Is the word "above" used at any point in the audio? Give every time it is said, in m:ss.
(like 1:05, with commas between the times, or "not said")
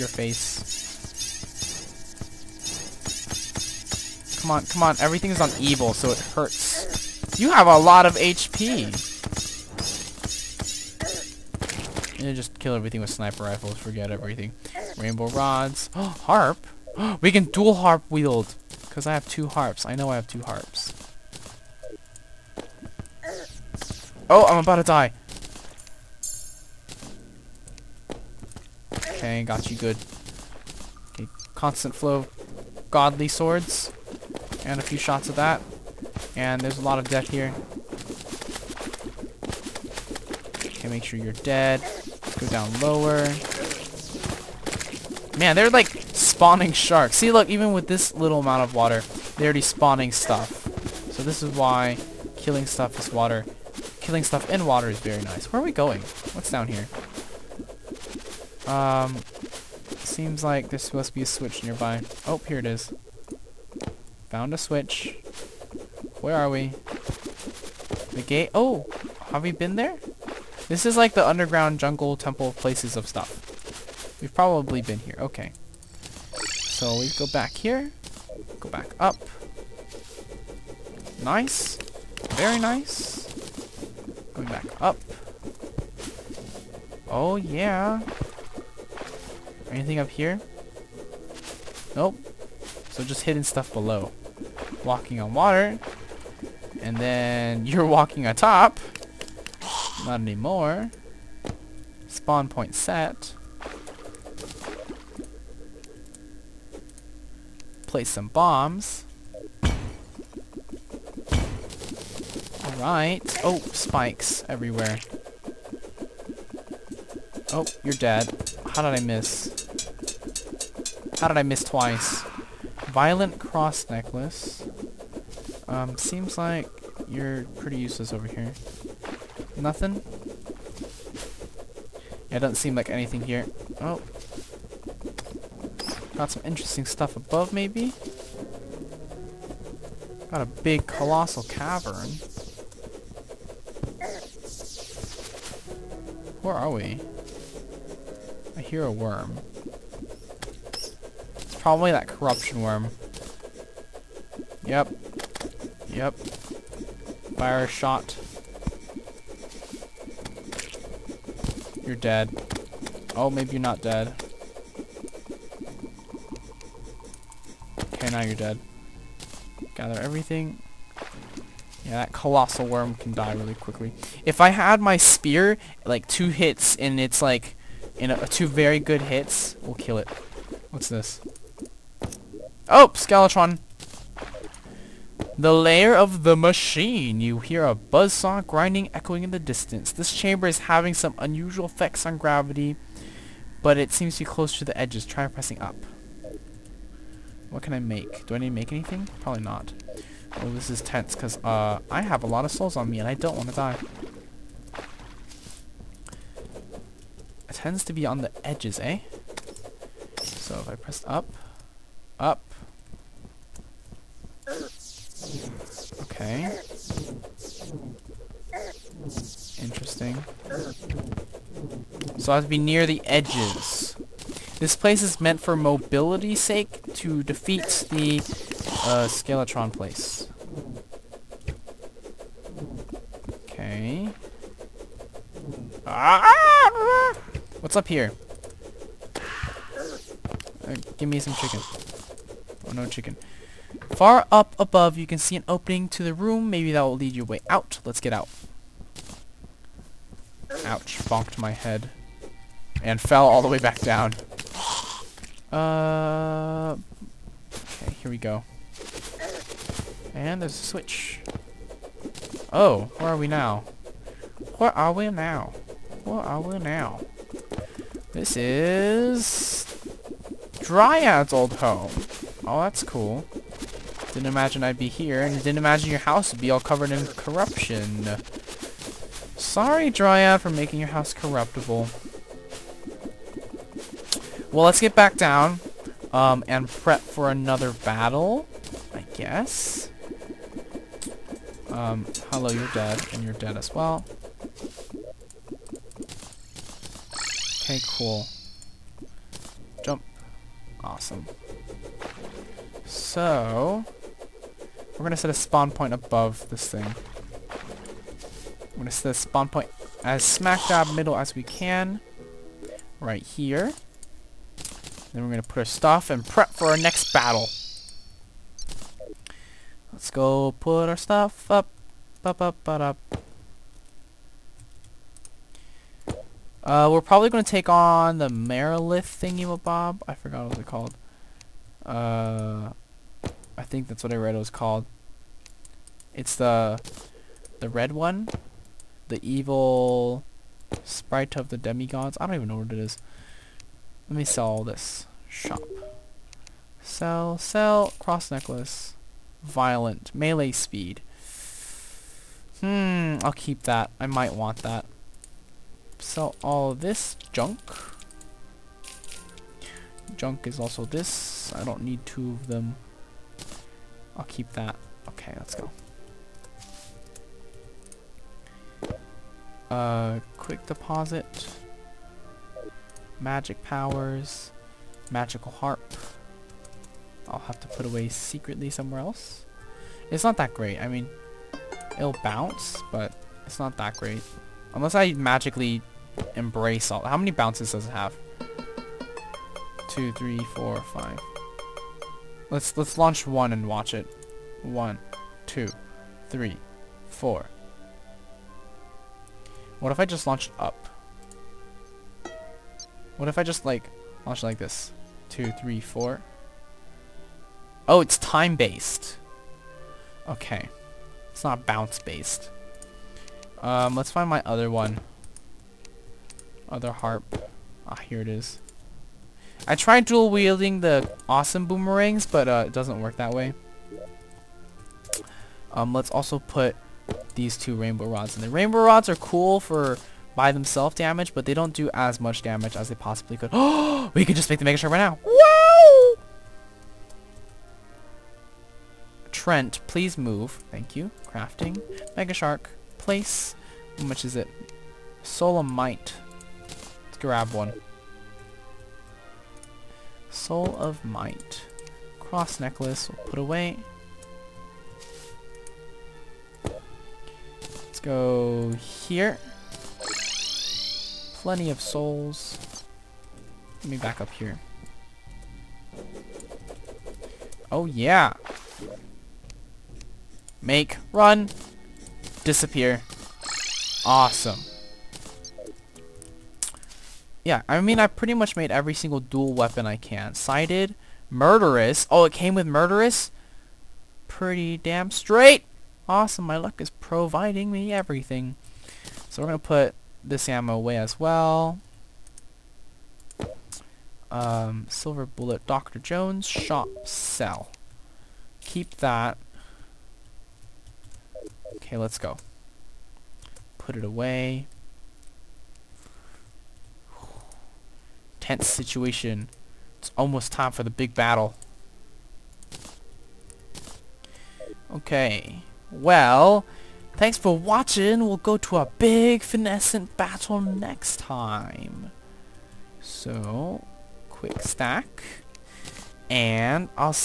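2:17, 4:04, 5:05.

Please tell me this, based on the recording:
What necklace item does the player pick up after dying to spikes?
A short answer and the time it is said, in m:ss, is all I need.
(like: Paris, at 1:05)
Violent cross necklace, at 2:02.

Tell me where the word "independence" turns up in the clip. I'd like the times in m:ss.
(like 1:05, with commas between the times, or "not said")
not said.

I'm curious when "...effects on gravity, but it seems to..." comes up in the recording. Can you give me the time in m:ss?
3:11.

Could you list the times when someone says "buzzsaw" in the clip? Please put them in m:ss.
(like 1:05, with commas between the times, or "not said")
3:07.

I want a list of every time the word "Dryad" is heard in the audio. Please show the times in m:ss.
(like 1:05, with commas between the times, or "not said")
4:30, 4:39.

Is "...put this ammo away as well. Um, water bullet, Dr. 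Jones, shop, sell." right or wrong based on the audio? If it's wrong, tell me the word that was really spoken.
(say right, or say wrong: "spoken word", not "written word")
wrong: "silver", not "water".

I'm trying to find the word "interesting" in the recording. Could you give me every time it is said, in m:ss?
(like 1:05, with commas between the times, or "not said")
2:16, 3:39.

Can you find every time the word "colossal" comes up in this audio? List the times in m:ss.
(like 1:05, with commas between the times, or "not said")
2:20, 2:52.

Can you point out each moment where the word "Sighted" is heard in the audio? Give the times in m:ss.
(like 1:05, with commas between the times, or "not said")
8:00.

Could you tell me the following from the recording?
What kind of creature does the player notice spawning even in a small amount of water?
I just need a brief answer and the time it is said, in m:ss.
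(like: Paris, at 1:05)
Sharks, at 0:46.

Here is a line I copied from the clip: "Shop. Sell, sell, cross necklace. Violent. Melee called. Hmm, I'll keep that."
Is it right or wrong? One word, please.
wrong.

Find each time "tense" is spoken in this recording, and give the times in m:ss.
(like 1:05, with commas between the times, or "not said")
3:20, 8:28.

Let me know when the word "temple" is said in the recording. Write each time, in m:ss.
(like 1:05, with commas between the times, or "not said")
1:12.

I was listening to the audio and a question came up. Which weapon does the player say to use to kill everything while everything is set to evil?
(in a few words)
Sniper rifles.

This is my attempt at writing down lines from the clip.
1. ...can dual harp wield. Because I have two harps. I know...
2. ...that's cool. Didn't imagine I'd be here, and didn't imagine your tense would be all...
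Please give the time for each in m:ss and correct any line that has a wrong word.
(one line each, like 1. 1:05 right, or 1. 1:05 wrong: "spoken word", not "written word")
1. 0:17 right
2. 4:32 wrong: "house", not "tense".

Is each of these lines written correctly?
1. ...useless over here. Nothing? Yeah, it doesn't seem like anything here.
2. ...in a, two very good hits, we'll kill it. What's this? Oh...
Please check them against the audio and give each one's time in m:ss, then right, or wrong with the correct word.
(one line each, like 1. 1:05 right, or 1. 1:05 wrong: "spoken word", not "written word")
1. 2:07 right
2. 2:57 right.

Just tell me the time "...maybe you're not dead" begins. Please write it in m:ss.
2:43.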